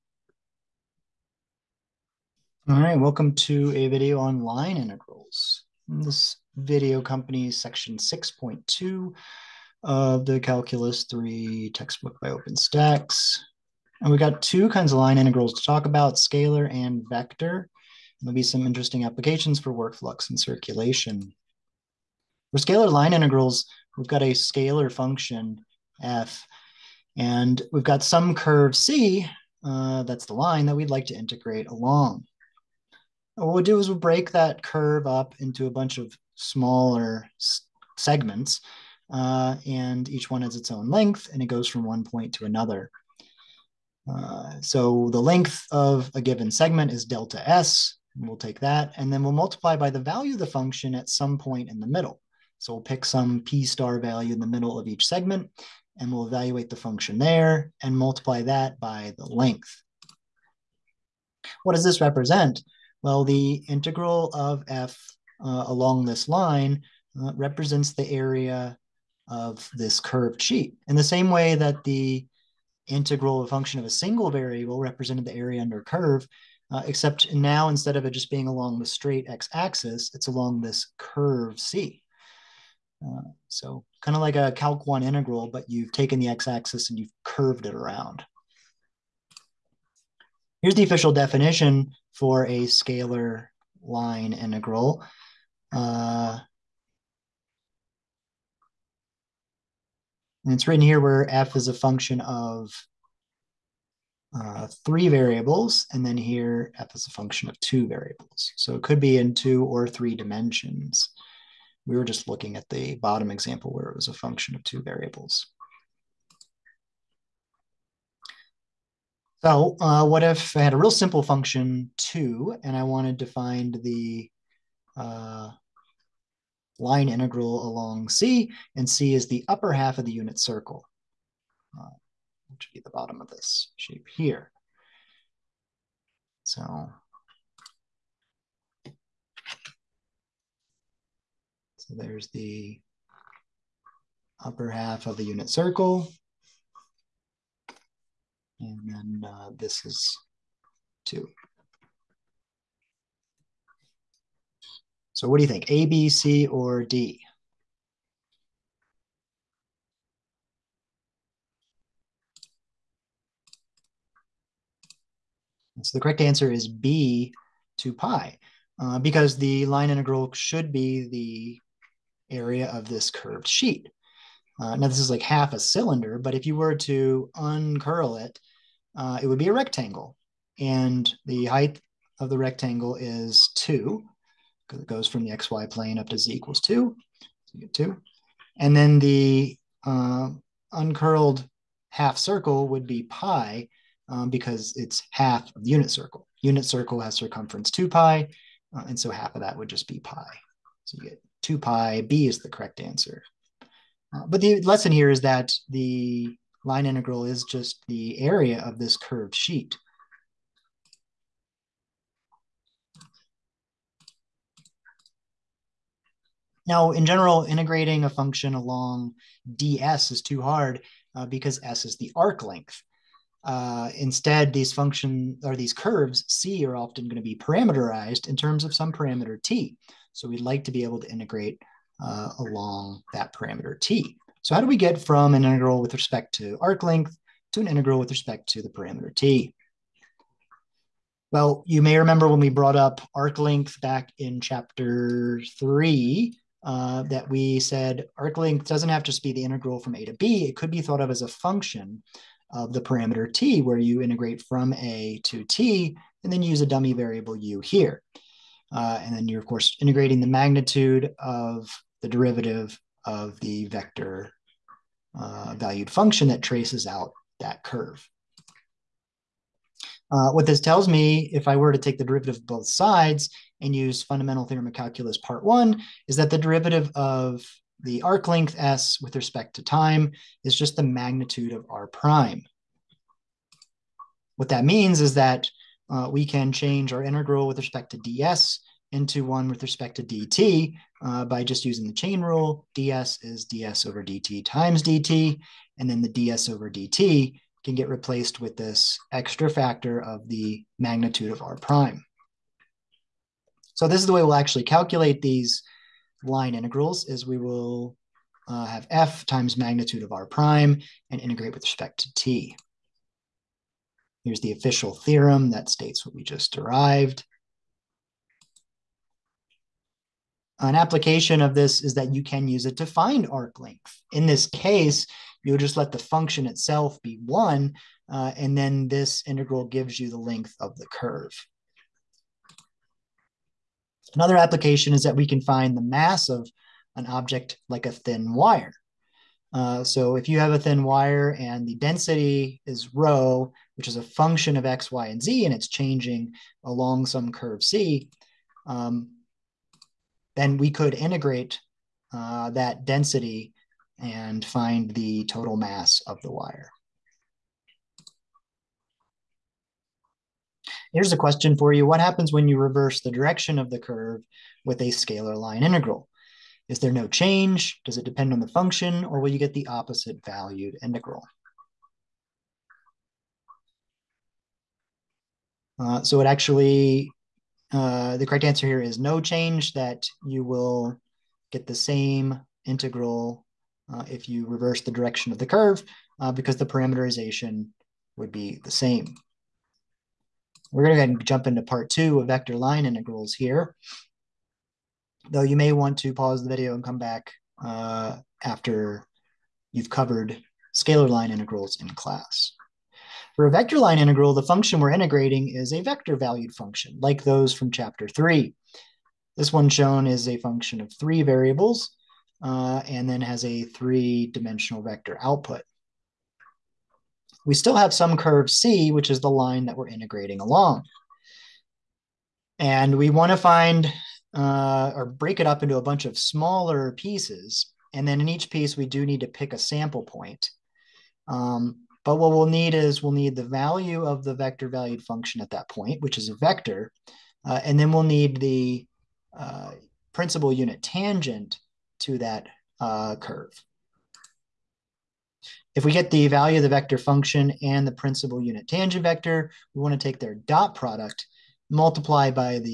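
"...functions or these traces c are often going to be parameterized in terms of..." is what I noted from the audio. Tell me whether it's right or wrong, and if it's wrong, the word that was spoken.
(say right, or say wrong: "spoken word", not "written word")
wrong: "curves", not "traces".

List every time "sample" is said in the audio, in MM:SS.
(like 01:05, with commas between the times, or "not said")
07:09.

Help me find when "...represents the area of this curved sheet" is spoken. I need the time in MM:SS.
01:07.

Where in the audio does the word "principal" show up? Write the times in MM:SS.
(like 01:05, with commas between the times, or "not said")
07:20, 07:27.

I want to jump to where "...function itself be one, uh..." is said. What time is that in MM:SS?
05:25.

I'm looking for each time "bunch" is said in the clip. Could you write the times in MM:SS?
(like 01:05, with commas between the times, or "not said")
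00:35, 07:05.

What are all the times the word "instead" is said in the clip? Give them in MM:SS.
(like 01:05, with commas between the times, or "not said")
01:17, 03:43.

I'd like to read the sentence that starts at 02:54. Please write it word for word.
Uh, now this is like half a cylinder, but if you were to uncurl it uh, it would be a rectangle.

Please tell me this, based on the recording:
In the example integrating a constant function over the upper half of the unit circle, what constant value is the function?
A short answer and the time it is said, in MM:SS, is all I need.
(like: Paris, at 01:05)
2, at 02:00.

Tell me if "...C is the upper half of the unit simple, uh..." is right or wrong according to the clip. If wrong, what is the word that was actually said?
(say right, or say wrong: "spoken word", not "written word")
wrong: "circle", not "simple".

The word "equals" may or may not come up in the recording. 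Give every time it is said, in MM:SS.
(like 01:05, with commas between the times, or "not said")
03:06.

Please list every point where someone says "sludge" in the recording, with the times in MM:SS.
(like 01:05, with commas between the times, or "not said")
not said.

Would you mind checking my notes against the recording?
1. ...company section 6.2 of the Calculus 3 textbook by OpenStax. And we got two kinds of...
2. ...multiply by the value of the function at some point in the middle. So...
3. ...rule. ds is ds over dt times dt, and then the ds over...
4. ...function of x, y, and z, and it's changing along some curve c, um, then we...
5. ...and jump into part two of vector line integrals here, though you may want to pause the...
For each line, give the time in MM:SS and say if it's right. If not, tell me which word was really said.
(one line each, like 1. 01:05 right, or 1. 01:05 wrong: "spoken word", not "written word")
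1. 00:07 right
2. 00:49 right
3. 04:52 right
4. 05:44 right
5. 06:31 right.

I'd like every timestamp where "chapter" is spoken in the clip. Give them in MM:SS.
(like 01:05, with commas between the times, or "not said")
04:04, 06:47.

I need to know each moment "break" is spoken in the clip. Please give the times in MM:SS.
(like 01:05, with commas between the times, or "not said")
00:33, 07:05.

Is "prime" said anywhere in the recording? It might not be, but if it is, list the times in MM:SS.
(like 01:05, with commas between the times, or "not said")
04:41, 05:01, 05:10.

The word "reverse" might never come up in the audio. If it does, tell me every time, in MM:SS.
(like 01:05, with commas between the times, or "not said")
06:02, 06:24.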